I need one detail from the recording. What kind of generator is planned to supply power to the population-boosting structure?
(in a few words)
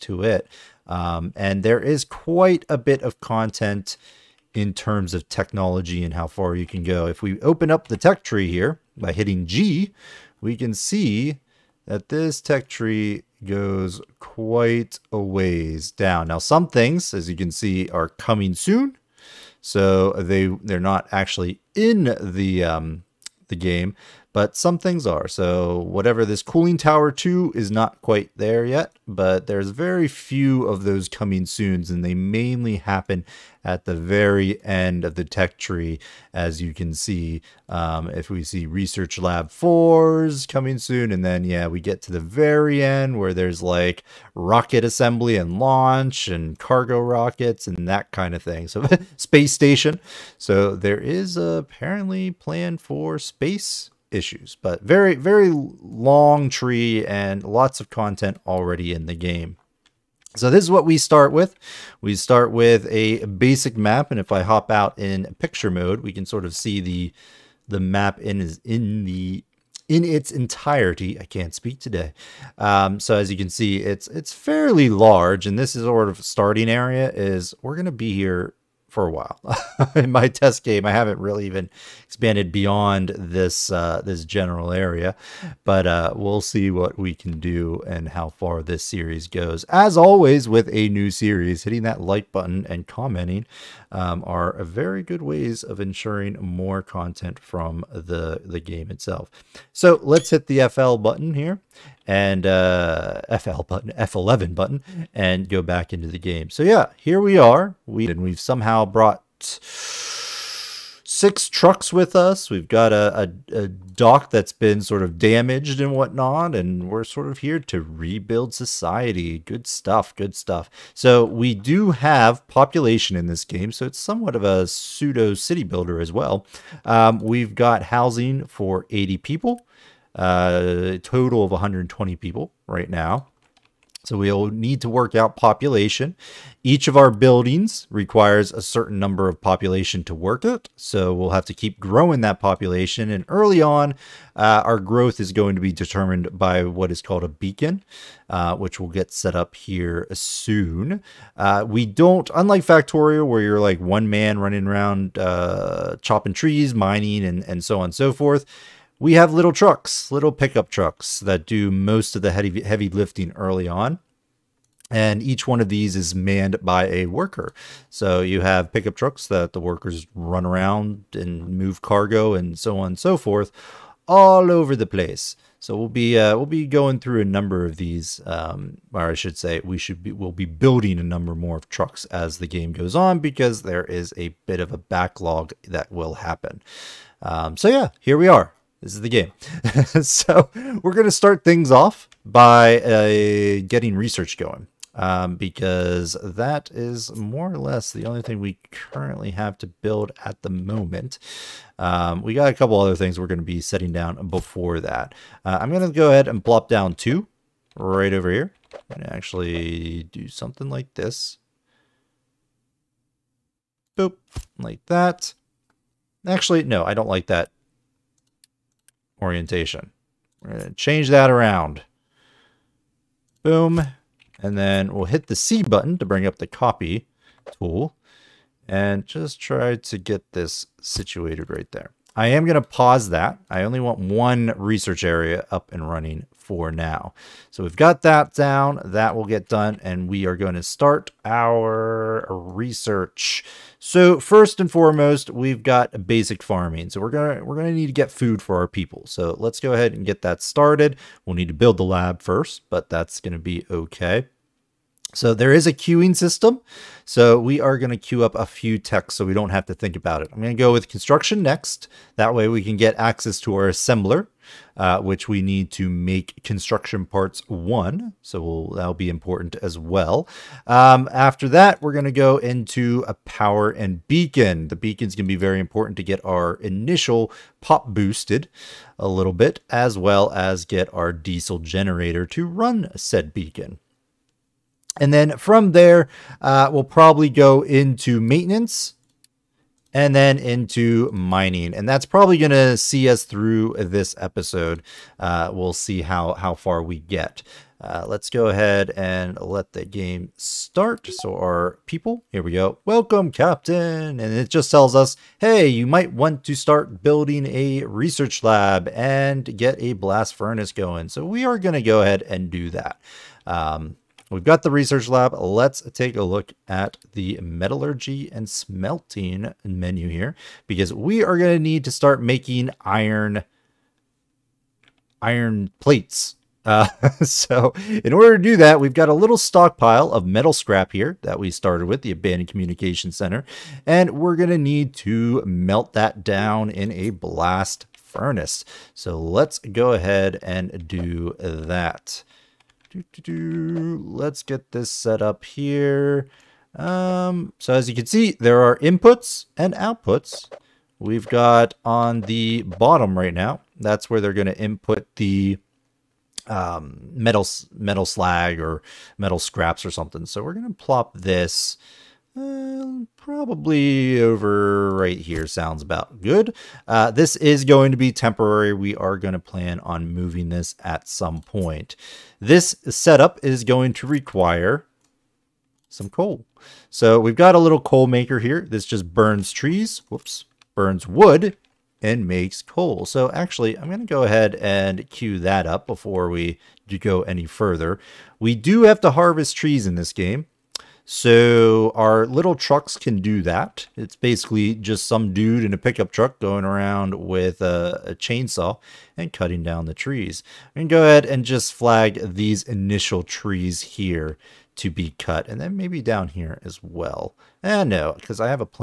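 diesel generator.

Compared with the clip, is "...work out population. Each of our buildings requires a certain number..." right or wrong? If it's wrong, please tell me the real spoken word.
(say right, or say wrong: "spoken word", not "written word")
right.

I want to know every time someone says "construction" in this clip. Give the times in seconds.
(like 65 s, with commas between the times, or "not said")
260 s, 266 s.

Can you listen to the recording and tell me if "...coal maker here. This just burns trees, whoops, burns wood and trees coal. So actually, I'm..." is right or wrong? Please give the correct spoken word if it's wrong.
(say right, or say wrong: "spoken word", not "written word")
wrong: "makes", not "trees".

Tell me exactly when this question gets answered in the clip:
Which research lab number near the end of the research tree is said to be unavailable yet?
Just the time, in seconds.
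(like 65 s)
38 s.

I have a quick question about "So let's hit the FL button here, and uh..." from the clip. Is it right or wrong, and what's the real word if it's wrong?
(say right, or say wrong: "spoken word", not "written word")
right.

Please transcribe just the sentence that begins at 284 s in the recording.
And then from there, uh, we'll probably go into maintenance and then into mining.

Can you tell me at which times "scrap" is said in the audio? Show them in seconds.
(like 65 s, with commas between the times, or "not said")
330 s, 359 s.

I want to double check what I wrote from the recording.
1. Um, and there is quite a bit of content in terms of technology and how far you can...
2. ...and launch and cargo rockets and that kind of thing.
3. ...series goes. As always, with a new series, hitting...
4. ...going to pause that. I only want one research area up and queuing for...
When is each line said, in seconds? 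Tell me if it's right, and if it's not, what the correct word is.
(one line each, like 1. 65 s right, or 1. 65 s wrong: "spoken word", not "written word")
1. 0 s right
2. 45 s right
3. 88 s right
4. 232 s wrong: "running", not "queuing".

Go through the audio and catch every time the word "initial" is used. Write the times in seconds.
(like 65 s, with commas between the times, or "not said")
276 s, 402 s.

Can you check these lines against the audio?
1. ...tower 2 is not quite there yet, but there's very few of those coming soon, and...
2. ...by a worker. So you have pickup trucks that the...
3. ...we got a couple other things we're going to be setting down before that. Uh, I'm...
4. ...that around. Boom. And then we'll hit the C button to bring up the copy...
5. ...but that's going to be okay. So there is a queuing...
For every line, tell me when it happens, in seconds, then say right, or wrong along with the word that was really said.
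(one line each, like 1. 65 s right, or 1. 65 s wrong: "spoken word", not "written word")
1. 26 s right
2. 166 s right
3. 202 s right
4. 221 s right
5. 252 s right.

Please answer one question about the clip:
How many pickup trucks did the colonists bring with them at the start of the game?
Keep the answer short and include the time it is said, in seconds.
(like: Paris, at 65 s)
6, at 109 s.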